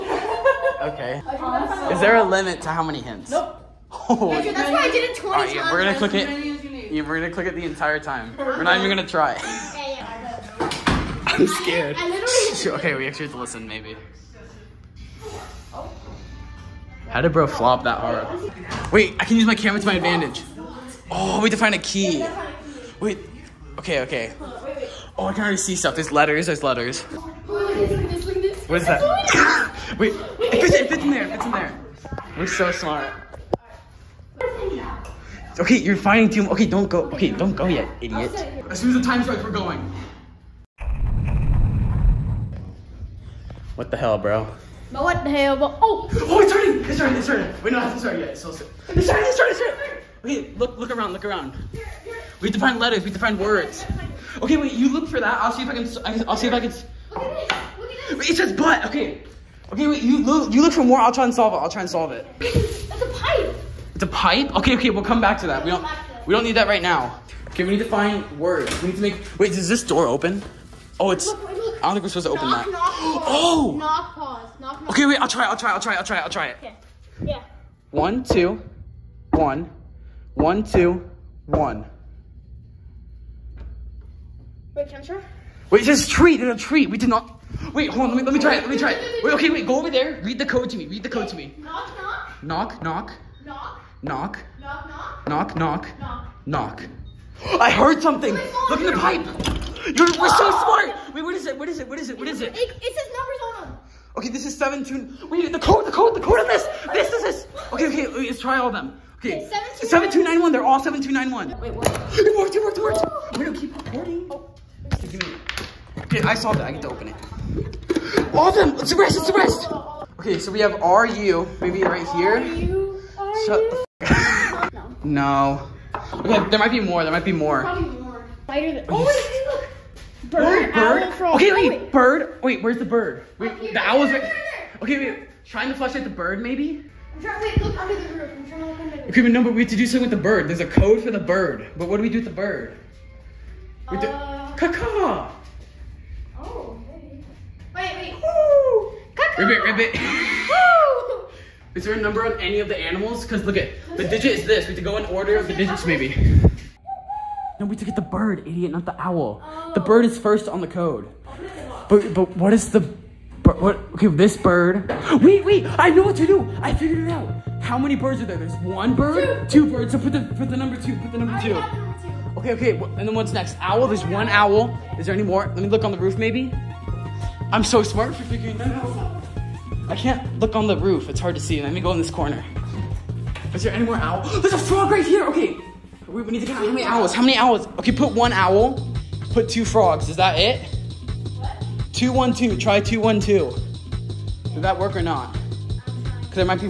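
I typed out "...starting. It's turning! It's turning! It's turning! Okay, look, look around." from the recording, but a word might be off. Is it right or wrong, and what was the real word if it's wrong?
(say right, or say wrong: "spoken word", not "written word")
right.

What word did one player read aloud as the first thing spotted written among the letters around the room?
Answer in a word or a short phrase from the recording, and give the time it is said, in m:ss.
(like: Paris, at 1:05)
butt, at 0:58.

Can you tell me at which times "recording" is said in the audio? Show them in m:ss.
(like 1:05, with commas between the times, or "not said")
1:53.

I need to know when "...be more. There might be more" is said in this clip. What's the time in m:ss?
2:06.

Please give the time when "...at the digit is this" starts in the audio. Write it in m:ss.
2:33.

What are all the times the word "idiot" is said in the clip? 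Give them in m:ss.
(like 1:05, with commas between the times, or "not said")
0:38, 2:38.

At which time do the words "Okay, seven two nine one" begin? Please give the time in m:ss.
1:49.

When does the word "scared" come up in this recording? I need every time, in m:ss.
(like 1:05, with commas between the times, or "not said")
0:11.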